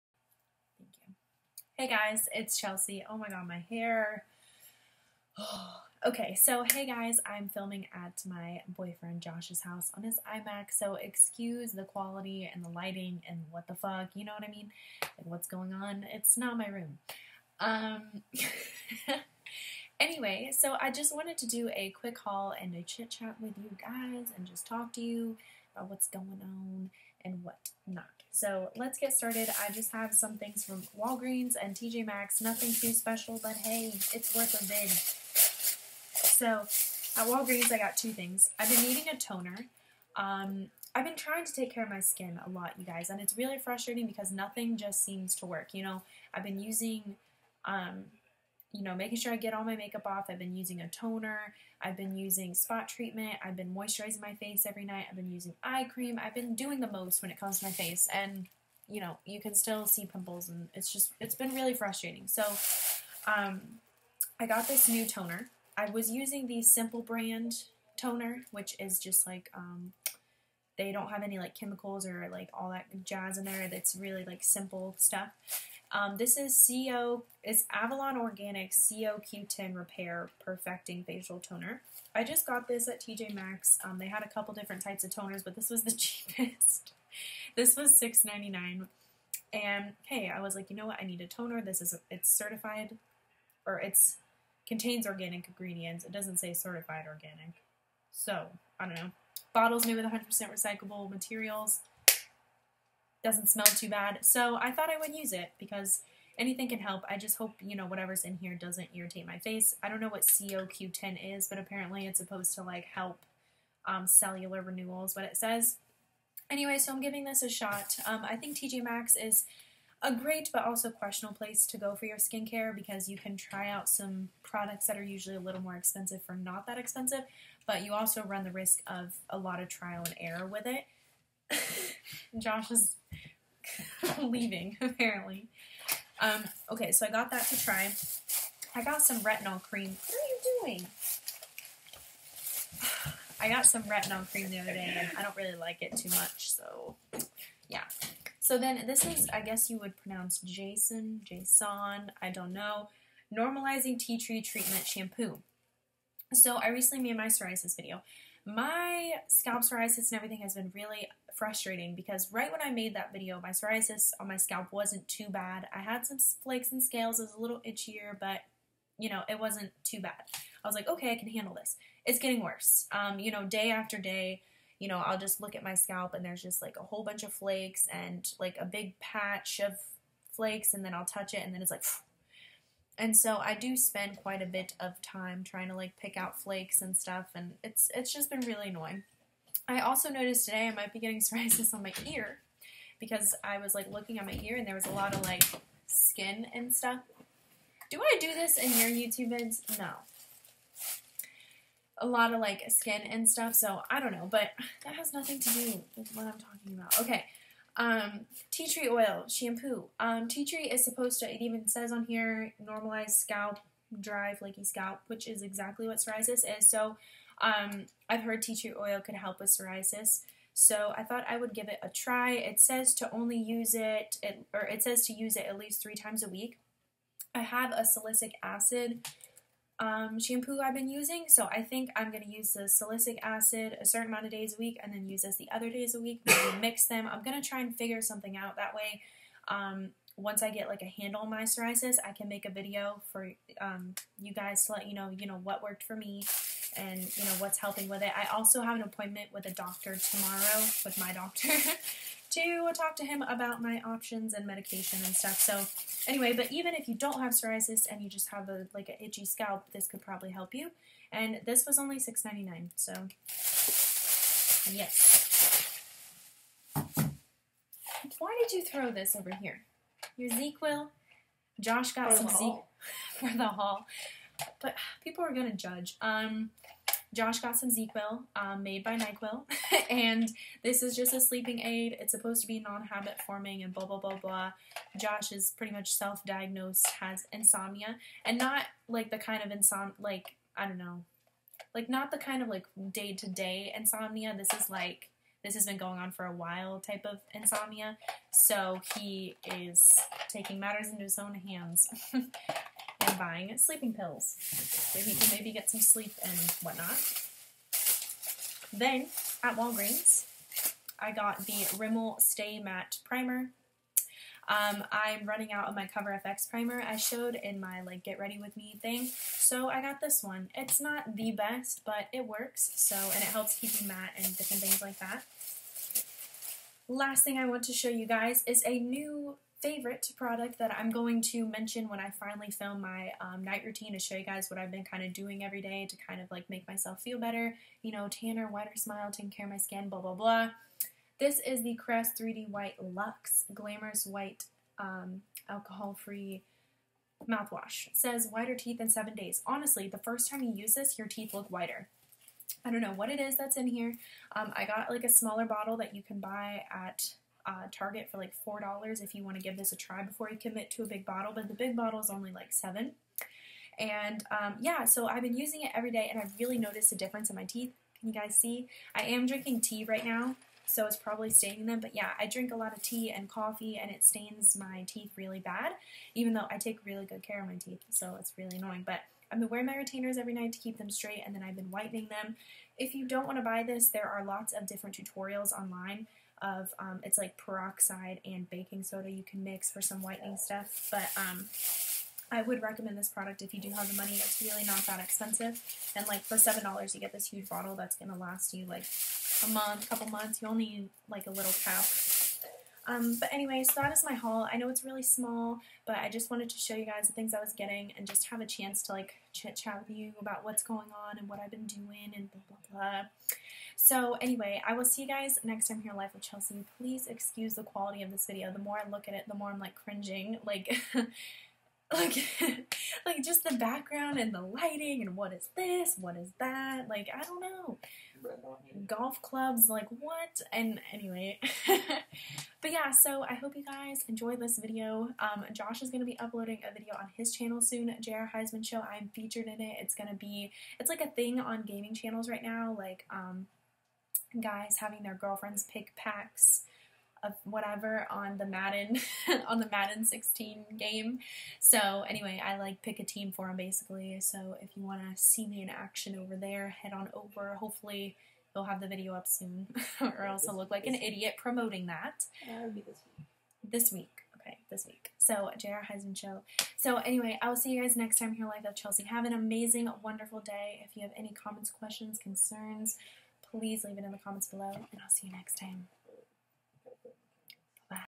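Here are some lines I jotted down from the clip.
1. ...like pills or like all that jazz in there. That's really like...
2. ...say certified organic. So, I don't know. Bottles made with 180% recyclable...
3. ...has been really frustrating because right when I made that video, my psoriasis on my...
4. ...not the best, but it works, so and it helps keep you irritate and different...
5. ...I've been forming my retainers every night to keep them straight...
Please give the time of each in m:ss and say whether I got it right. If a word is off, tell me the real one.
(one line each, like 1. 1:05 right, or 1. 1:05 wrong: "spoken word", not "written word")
1. 1:11 wrong: "chemicals", not "pills"
2. 1:36 wrong: "100", not "180"
3. 2:40 right
4. 5:20 wrong: "matte", not "irritate"
5. 6:19 wrong: "wearing", not "forming".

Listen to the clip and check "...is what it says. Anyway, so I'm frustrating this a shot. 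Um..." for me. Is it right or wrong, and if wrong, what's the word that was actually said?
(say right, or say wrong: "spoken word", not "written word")
wrong: "giving", not "frustrating".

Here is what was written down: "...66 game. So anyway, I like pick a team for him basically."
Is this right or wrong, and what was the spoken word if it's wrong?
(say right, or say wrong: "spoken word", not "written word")
wrong: "16", not "66".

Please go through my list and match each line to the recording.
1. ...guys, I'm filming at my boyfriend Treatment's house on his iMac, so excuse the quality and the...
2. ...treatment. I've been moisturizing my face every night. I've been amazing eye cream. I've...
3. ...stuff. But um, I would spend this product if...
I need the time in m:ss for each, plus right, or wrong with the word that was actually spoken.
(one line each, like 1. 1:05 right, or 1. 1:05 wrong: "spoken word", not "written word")
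1. 0:06 wrong: "Josh", not "Treatment"
2. 0:52 wrong: "using", not "amazing"
3. 6:30 wrong: "recommend", not "spend".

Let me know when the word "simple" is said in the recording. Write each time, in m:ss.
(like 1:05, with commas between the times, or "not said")
1:06, 1:14.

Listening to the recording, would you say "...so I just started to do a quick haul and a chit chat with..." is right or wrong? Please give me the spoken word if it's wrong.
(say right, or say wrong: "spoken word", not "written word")
wrong: "wanted", not "started".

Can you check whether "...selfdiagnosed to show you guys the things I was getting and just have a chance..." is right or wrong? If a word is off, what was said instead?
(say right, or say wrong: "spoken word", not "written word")
wrong: "wanted", not "selfdiagnosed".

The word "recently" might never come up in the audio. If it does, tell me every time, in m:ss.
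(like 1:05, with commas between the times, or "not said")
2:36.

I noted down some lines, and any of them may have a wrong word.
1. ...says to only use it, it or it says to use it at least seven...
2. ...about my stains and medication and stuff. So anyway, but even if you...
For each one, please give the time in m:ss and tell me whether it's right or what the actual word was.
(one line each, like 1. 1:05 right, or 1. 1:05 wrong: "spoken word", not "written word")
1. 3:42 wrong: "three", not "seven"
2. 4:13 wrong: "options", not "stains".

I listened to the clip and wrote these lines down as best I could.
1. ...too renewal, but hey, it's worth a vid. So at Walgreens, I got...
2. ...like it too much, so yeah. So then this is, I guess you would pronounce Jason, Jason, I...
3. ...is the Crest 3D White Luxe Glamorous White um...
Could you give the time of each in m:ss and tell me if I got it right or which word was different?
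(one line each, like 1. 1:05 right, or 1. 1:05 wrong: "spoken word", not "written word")
1. 0:32 wrong: "special", not "renewal"
2. 2:25 right
3. 5:41 right.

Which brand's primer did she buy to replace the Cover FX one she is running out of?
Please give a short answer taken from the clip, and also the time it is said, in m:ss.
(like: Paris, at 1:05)
Rimmel, at 5:11.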